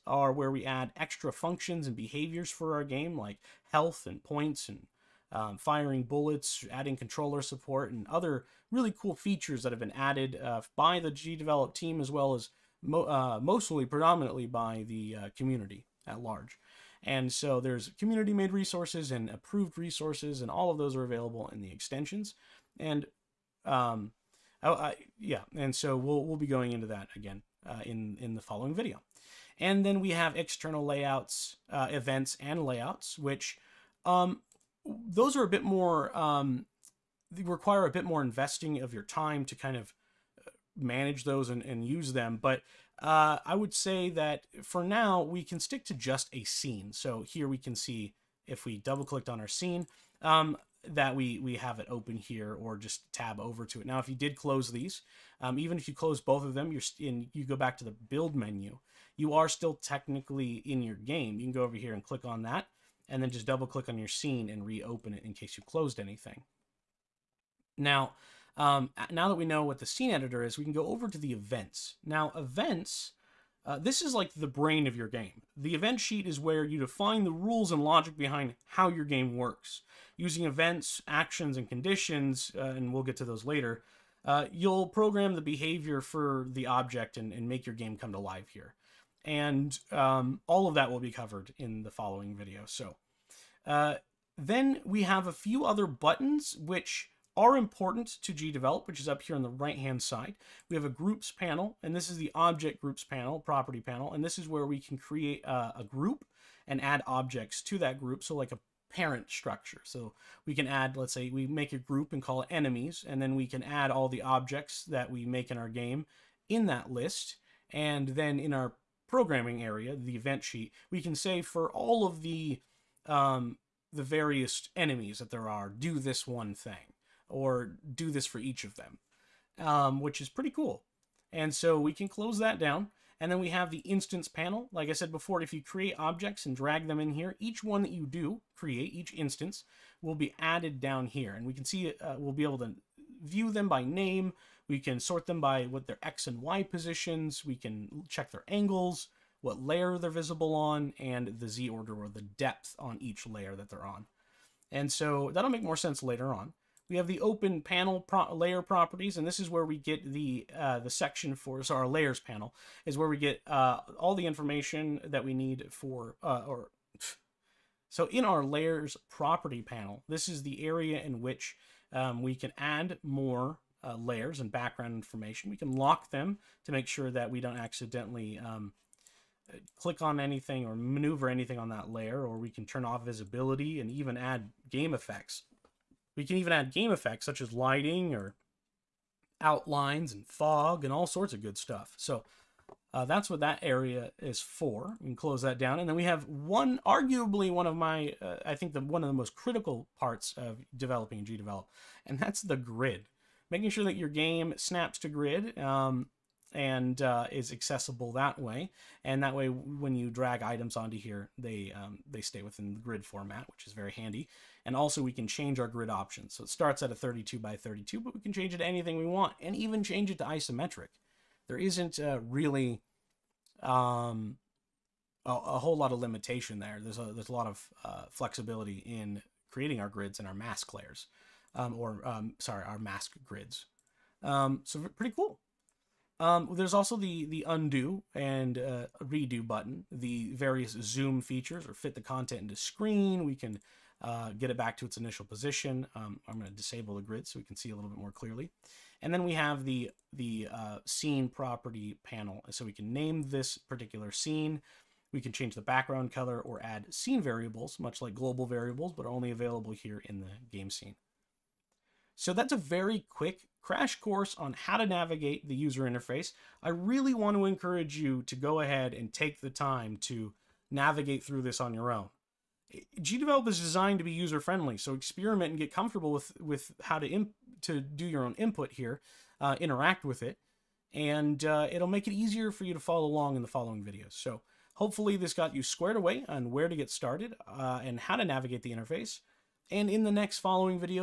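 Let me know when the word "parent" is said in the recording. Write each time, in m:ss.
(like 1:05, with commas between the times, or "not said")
1:48.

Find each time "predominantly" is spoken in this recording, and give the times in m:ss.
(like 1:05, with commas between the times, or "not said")
0:13.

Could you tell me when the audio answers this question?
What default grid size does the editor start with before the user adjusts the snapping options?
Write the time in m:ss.
3:36.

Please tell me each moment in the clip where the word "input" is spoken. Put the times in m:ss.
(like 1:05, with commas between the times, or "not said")
4:38.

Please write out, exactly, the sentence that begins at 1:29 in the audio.
And um, all of that will be covered in the following video.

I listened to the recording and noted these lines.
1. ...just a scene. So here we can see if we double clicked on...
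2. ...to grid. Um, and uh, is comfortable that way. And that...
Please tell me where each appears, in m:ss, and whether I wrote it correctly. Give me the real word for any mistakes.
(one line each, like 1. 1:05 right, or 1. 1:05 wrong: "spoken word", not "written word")
1. 0:45 right
2. 3:24 wrong: "accessible", not "comfortable".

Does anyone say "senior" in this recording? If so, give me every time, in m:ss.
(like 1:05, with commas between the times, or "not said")
not said.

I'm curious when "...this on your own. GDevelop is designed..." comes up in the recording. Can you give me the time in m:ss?
4:31.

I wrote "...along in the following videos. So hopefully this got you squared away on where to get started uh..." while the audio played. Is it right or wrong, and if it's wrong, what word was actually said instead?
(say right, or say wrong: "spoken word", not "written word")
right.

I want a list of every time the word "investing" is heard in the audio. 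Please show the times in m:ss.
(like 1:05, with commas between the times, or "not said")
0:38.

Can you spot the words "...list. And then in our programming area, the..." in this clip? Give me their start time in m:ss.
1:56.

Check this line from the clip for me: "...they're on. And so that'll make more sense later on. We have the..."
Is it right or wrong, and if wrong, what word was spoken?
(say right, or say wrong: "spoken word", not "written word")
right.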